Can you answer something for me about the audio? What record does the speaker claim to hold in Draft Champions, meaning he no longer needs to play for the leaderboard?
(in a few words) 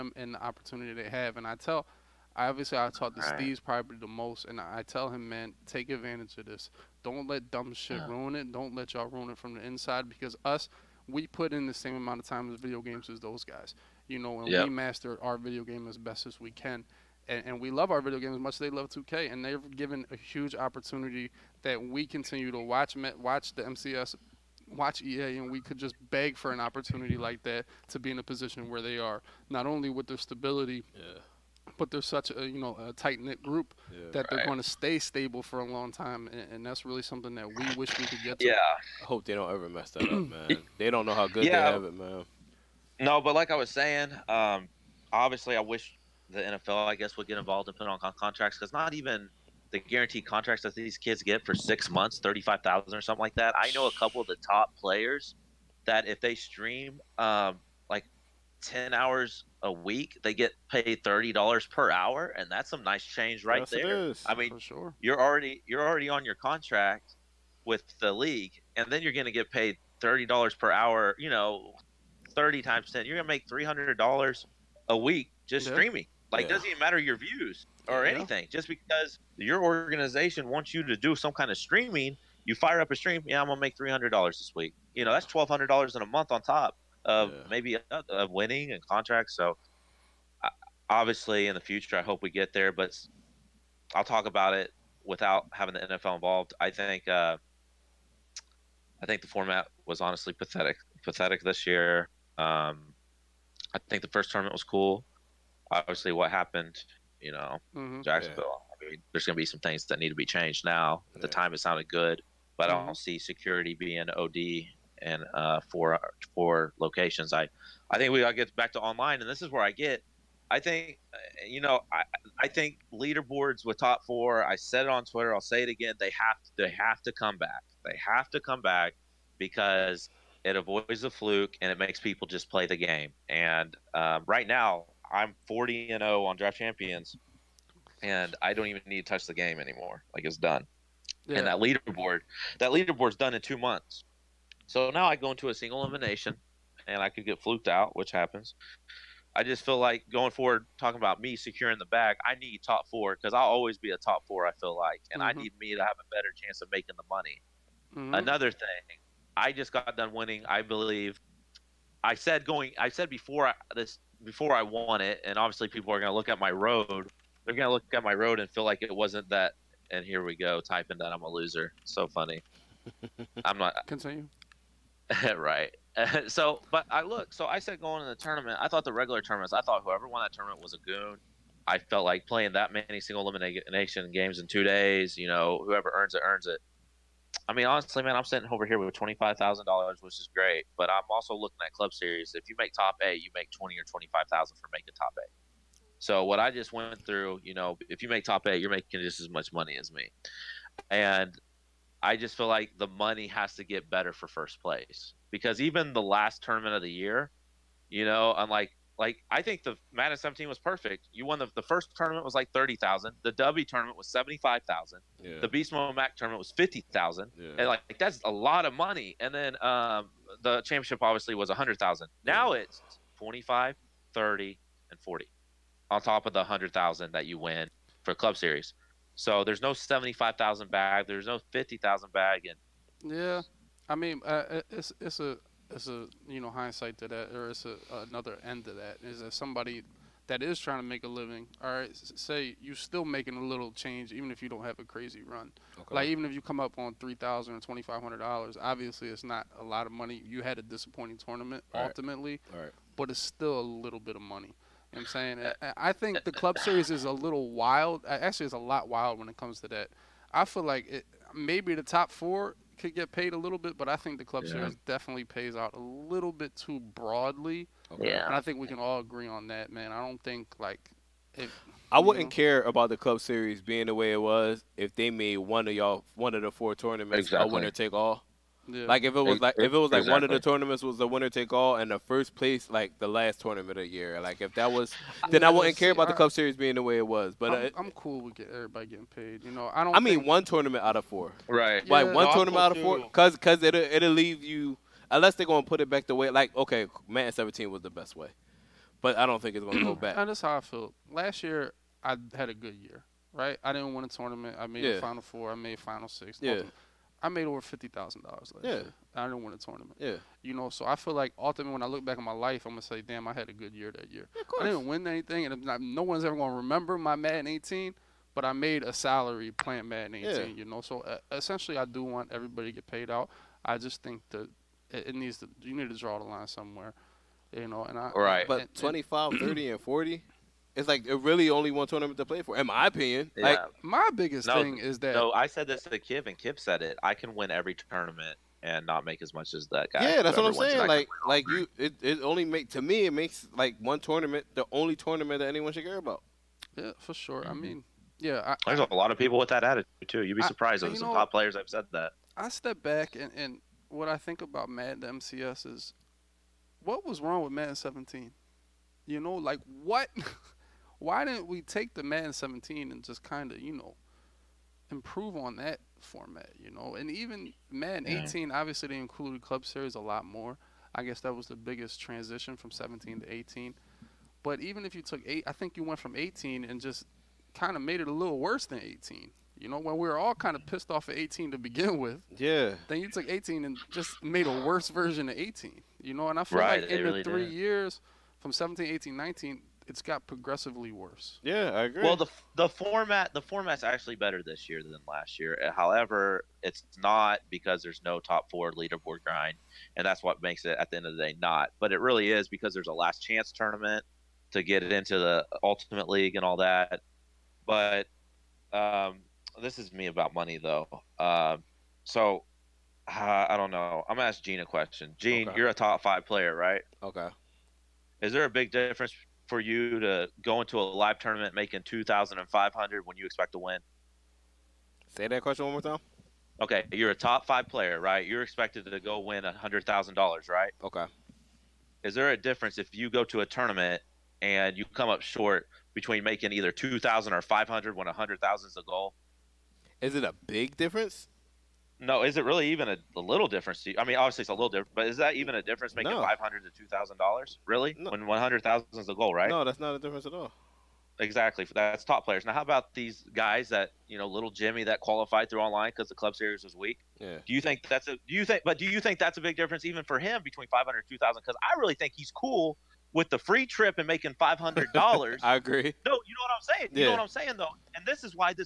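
40 and 0.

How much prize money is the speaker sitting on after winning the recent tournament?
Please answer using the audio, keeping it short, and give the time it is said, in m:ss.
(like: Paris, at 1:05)
$25,000, at 3:08.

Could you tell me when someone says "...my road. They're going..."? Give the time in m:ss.
2:46.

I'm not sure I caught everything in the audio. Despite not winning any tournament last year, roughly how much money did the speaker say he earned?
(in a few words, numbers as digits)
over $50,000.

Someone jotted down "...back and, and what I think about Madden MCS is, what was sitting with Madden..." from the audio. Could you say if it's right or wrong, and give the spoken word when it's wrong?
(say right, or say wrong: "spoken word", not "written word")
wrong: "wrong", not "sitting".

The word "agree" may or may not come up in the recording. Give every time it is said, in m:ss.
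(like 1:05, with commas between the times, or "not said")
4:29, 6:31, 7:45.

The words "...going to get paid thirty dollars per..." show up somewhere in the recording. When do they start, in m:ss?
1:09.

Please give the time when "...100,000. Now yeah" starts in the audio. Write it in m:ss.
3:41.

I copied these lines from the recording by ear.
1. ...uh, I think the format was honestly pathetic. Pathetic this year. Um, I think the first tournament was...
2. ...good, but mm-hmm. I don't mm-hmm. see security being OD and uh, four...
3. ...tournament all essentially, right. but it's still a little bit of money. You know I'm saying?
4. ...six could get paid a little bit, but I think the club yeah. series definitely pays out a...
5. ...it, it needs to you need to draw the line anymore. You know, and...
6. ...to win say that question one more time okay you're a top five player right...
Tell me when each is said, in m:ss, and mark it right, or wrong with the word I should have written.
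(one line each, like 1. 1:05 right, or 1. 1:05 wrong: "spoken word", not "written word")
1. 1:37 right
2. 1:51 right
3. 4:11 wrong: "ultimately", not "essentially"
4. 4:22 wrong: "four", not "six"
5. 5:24 wrong: "somewhere", not "anymore"
6. 7:03 right.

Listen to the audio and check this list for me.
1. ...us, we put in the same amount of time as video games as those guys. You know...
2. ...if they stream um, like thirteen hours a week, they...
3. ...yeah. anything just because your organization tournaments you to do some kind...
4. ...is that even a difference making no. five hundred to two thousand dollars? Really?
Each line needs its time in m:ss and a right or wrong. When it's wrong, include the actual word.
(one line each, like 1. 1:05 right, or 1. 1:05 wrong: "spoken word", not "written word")
1. 0:10 right
2. 0:56 wrong: "ten", not "thirteen"
3. 1:18 wrong: "wants", not "tournaments"
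4. 7:25 right.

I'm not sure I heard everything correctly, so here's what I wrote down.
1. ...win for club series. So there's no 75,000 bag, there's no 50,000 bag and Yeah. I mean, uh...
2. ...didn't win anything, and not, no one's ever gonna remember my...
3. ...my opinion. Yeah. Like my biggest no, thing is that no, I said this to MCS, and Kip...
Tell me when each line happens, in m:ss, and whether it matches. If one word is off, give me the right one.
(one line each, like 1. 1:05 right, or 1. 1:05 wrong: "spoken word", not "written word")
1. 3:47 right
2. 5:14 right
3. 5:32 wrong: "Kip", not "MCS".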